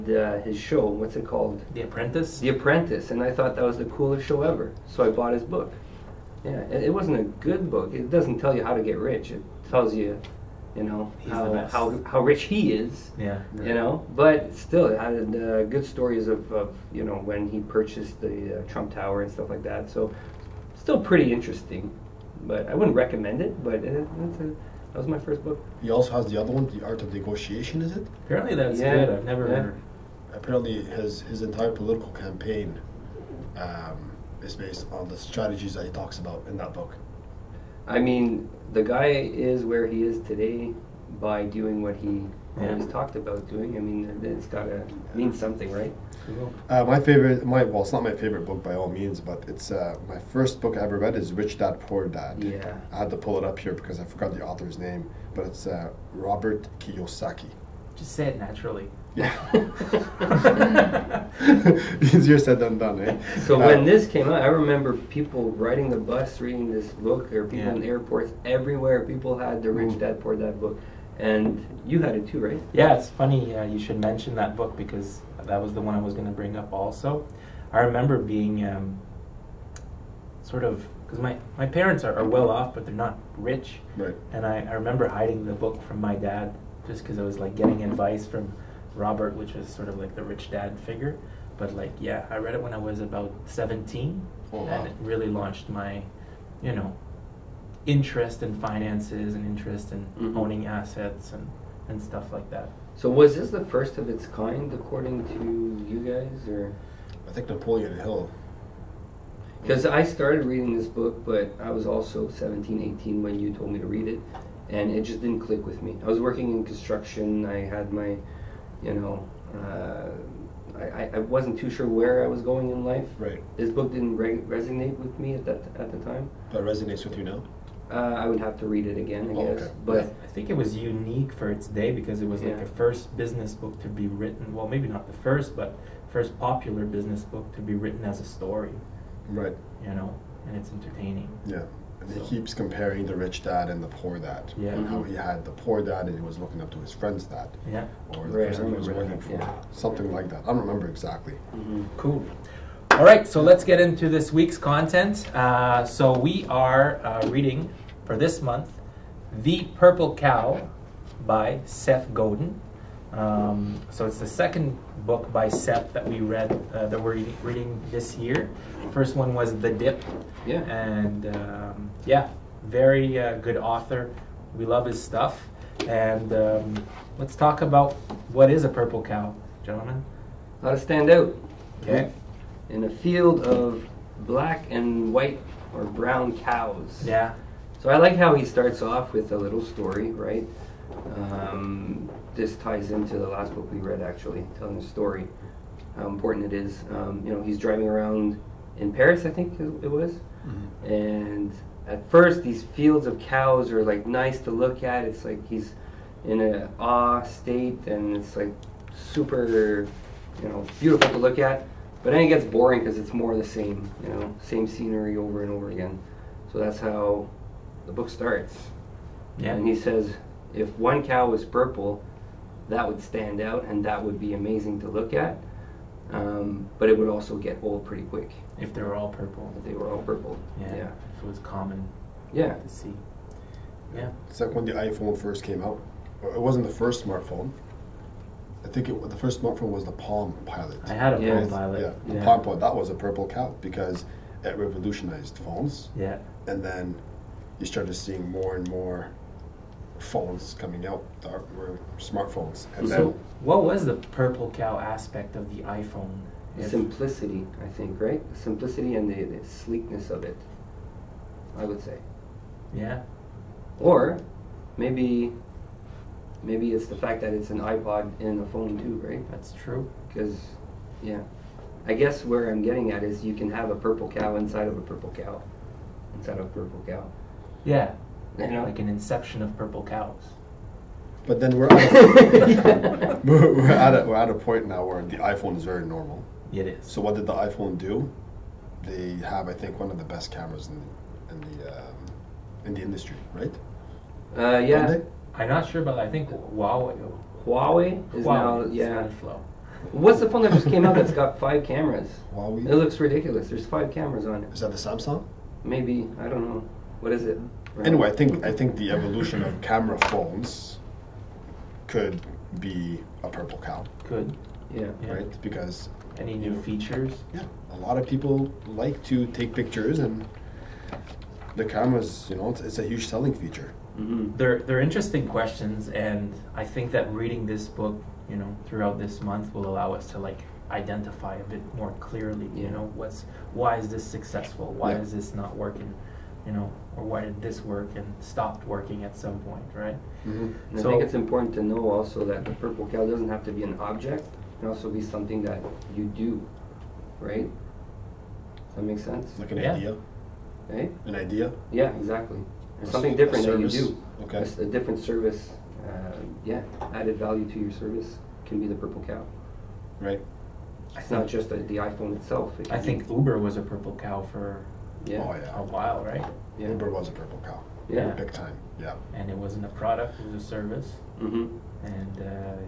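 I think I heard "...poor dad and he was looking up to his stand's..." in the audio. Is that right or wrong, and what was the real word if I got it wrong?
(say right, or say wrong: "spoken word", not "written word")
wrong: "friend", not "stand".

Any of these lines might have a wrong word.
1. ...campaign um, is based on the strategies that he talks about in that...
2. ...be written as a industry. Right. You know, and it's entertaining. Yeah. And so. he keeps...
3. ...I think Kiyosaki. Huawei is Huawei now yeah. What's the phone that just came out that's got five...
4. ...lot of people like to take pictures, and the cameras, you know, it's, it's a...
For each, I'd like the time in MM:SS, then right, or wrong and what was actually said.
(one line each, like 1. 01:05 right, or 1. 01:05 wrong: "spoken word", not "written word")
1. 00:32 right
2. 02:17 wrong: "story", not "industry"
3. 04:55 wrong: "Huawei", not "Kiyosaki"
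4. 05:17 right.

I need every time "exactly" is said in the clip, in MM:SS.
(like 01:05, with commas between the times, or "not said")
02:30, 05:51.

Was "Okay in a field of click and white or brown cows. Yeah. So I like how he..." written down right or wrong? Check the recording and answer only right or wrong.
wrong.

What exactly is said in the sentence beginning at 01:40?
owning assets and, and stuff like that.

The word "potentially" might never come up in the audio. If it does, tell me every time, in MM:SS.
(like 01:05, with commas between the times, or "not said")
not said.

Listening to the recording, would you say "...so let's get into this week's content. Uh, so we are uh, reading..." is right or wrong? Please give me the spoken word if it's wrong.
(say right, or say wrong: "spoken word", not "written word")
right.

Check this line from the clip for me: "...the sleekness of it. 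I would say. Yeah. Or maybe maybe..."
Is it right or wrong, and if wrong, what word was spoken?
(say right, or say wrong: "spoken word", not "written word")
right.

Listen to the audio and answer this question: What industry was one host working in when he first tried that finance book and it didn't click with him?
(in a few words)
construction.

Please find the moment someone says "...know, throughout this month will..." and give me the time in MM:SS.
05:28.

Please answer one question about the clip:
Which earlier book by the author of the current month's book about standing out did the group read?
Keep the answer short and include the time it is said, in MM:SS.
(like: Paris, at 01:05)
The Dip, at 02:49.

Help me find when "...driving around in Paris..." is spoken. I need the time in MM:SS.
03:17.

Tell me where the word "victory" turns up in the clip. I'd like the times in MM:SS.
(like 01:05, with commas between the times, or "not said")
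not said.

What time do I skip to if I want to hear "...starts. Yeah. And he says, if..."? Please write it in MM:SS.
03:38.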